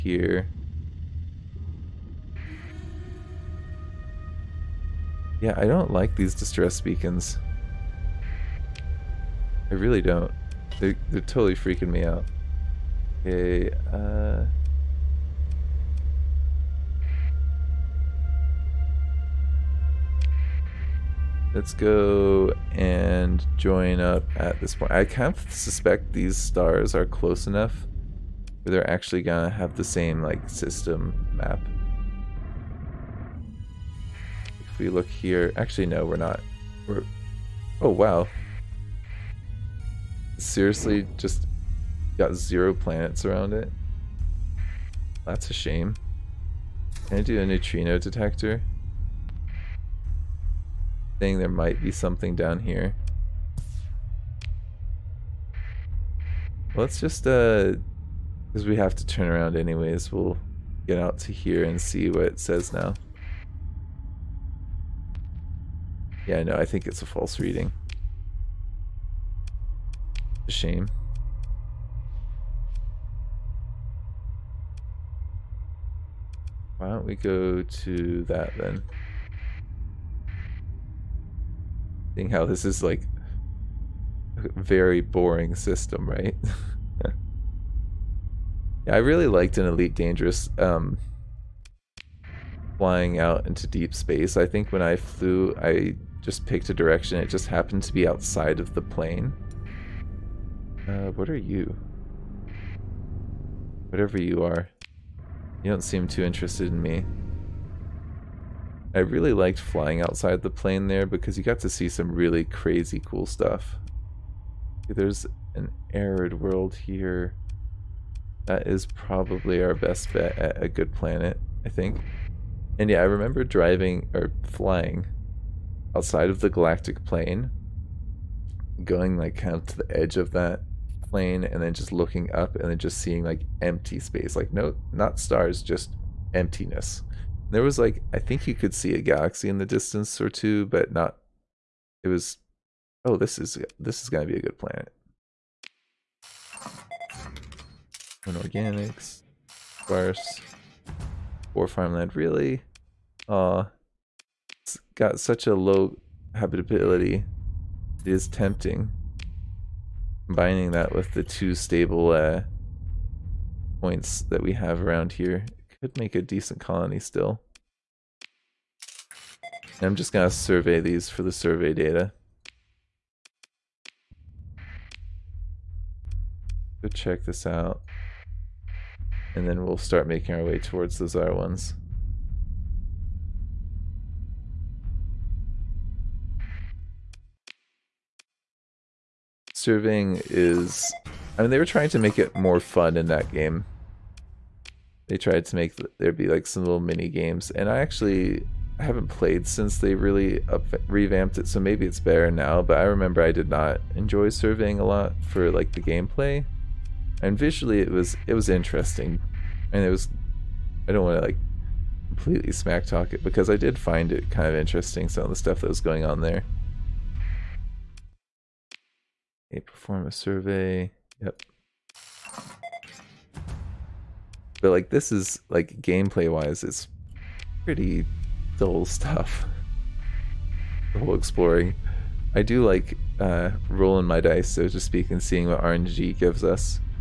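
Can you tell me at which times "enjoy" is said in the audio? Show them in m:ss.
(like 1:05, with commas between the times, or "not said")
3:23.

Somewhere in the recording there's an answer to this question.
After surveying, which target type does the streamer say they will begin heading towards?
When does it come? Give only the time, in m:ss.
3:01.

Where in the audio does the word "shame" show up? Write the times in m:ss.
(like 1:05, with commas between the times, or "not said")
0:45, 1:10.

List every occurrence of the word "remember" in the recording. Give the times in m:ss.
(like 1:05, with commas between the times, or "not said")
2:03, 3:22.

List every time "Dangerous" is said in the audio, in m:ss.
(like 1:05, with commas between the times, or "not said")
1:29.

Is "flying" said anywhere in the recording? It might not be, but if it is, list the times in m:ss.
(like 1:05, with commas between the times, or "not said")
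1:32, 1:49, 2:04.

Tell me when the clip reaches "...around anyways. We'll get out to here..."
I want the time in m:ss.
0:59.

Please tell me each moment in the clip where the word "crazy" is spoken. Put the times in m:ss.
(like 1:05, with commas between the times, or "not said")
1:52.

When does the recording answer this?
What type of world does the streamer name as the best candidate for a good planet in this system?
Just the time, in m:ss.
1:55.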